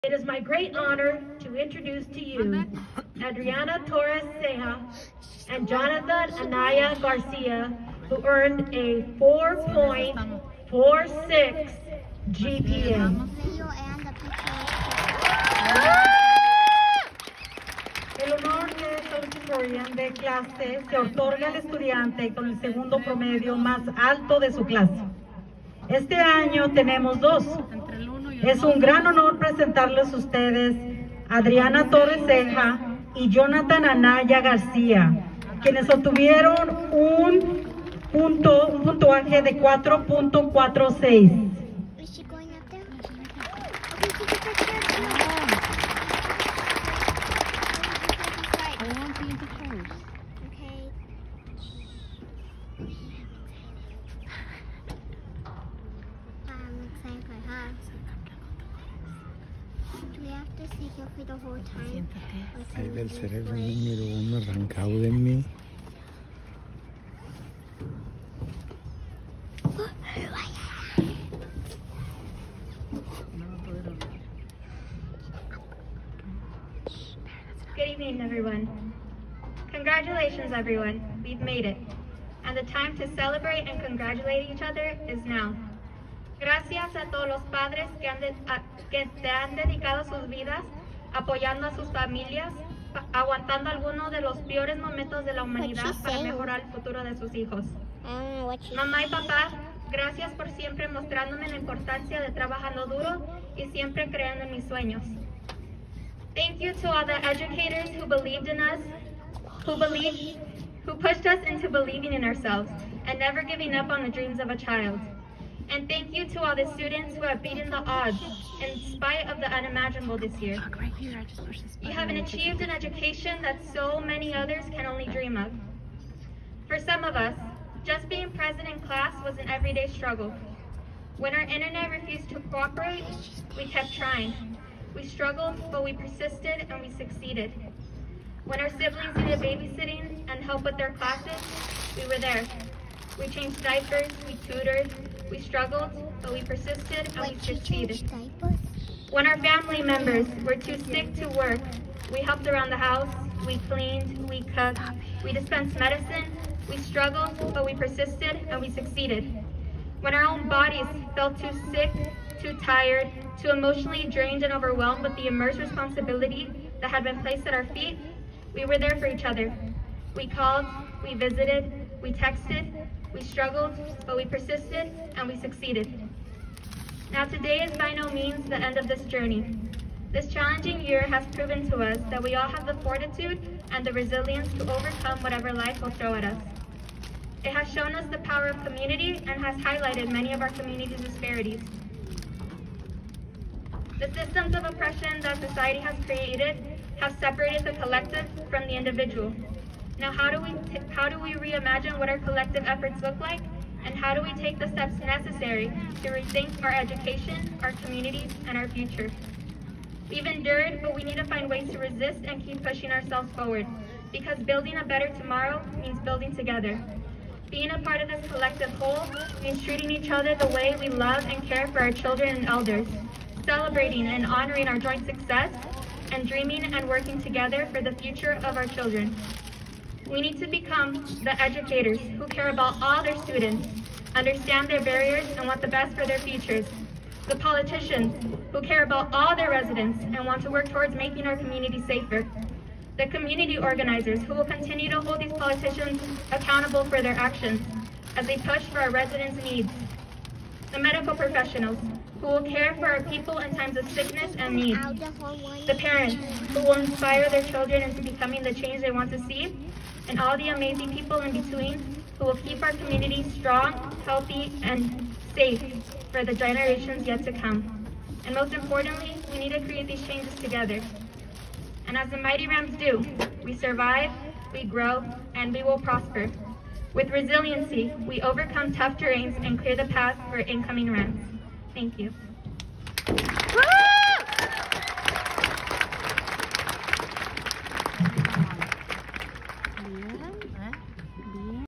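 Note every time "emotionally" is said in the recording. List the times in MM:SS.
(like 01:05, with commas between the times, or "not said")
02:43.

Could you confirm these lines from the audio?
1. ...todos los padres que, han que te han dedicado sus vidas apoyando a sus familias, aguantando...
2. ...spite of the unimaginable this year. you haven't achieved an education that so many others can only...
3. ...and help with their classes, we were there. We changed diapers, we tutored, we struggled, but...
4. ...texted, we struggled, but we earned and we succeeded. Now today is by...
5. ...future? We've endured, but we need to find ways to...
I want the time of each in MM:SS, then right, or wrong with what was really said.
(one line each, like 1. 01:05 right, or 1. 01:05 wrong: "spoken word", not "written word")
1. 01:27 right
2. 01:58 right
3. 02:20 right
4. 02:52 wrong: "persisted", not "earned"
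5. 03:28 right.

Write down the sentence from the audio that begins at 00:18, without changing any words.
El honor de Valedictorian de clase se otorga al estudiante con el segundo promedio más alto de su clase.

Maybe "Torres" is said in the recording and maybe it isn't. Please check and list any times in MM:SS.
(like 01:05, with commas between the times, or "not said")
00:03, 00:31.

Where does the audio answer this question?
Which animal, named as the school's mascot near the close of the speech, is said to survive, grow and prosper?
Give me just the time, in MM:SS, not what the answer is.
04:32.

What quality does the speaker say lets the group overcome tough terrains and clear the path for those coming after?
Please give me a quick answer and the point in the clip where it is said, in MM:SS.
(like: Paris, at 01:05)
resiliency, at 04:37.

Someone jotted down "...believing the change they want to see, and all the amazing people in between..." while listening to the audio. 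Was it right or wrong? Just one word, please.
wrong.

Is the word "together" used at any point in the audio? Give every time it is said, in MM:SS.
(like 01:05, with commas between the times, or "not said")
03:36, 03:47, 04:30.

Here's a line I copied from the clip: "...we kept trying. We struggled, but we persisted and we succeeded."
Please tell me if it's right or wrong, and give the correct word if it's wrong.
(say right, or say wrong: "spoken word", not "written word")
right.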